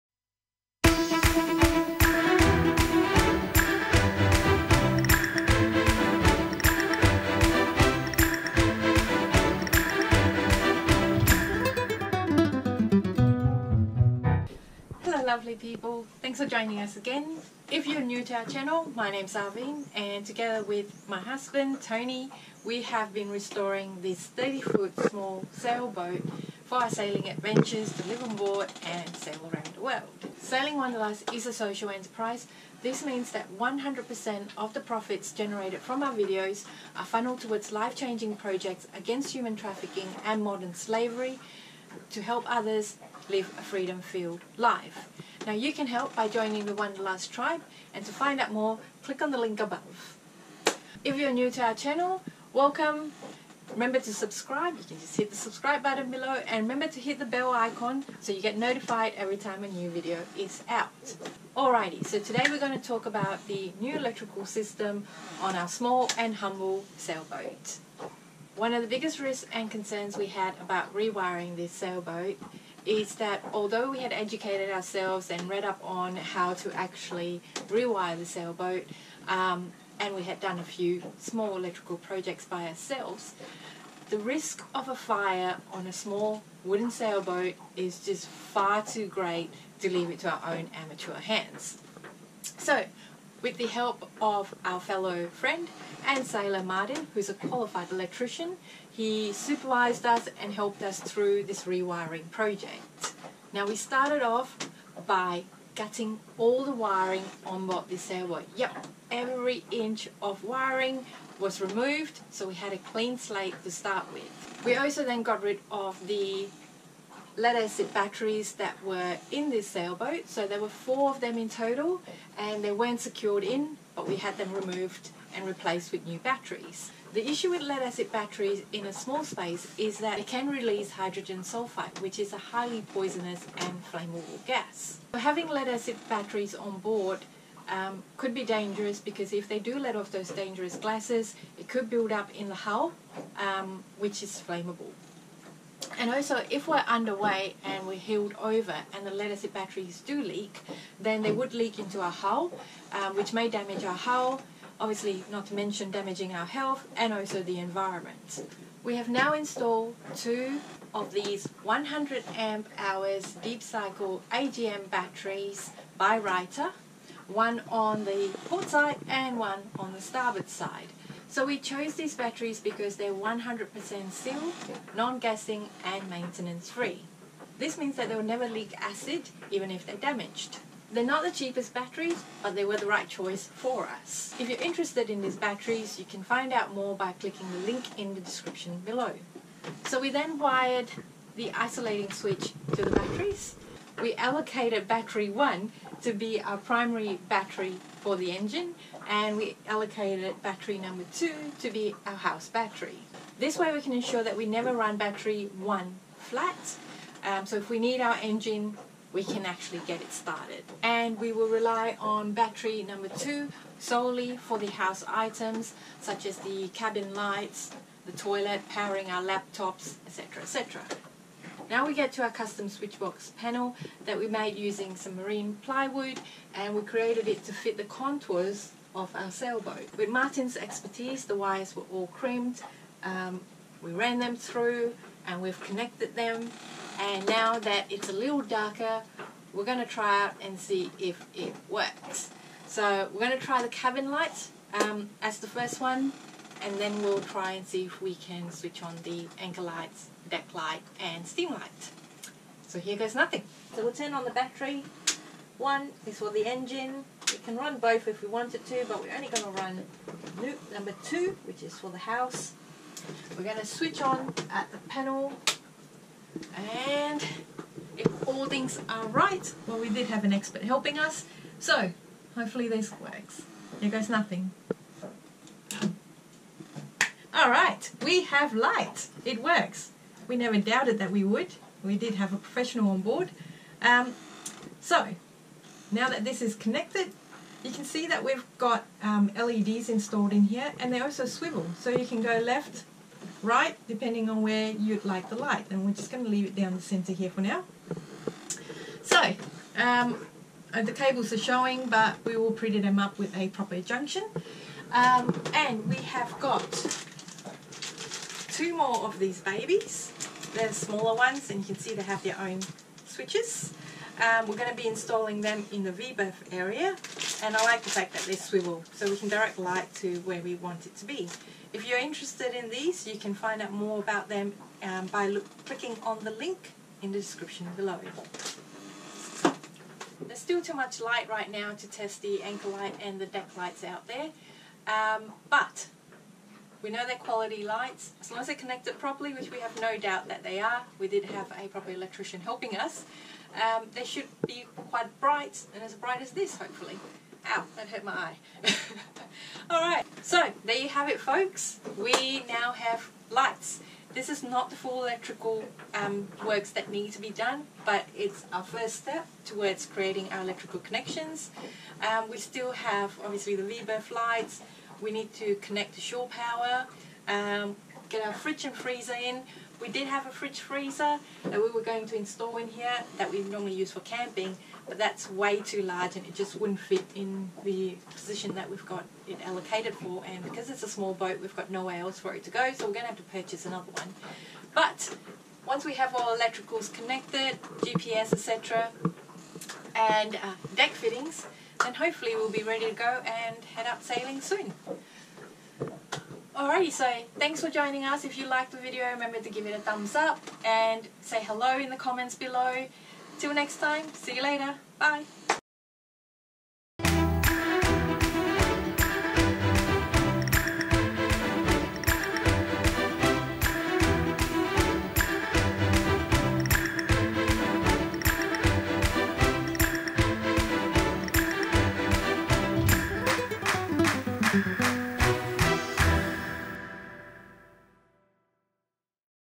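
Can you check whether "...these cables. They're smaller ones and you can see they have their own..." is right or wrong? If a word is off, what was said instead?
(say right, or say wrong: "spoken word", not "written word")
wrong: "babies", not "cables".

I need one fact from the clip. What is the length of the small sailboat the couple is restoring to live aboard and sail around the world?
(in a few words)
30 foot.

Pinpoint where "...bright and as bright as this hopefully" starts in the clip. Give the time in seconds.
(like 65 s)
345 s.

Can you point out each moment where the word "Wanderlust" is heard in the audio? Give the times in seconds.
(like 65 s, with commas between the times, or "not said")
30 s, 46 s.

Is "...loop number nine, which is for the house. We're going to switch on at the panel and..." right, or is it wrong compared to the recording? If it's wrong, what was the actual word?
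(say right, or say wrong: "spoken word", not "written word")
wrong: "two", not "nine".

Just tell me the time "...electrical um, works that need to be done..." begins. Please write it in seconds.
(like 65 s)
355 s.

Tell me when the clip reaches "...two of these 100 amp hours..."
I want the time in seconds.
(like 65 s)
160 s.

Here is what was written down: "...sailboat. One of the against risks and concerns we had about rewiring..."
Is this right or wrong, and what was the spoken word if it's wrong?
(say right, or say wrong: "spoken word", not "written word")
wrong: "biggest", not "against".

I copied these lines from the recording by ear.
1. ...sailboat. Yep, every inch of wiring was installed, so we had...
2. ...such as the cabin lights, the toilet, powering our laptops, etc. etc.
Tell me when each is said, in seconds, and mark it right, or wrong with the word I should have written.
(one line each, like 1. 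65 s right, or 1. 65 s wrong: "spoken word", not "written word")
1. 108 s wrong: "removed", not "installed"
2. 216 s right.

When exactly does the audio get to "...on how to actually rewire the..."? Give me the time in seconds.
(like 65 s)
75 s.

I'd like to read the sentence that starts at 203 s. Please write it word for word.
This way we can ensure that we never run battery one flat.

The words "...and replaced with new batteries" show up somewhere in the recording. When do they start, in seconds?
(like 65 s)
125 s.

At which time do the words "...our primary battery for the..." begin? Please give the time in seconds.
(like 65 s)
196 s.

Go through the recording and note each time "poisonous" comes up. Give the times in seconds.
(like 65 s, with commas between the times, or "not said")
132 s.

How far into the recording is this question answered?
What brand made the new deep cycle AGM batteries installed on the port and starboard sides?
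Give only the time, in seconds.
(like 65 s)
166 s.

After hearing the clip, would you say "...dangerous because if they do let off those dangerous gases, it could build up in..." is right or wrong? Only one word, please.
right.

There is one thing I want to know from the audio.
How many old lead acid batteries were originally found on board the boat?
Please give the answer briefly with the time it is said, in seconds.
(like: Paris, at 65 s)
4, at 120 s.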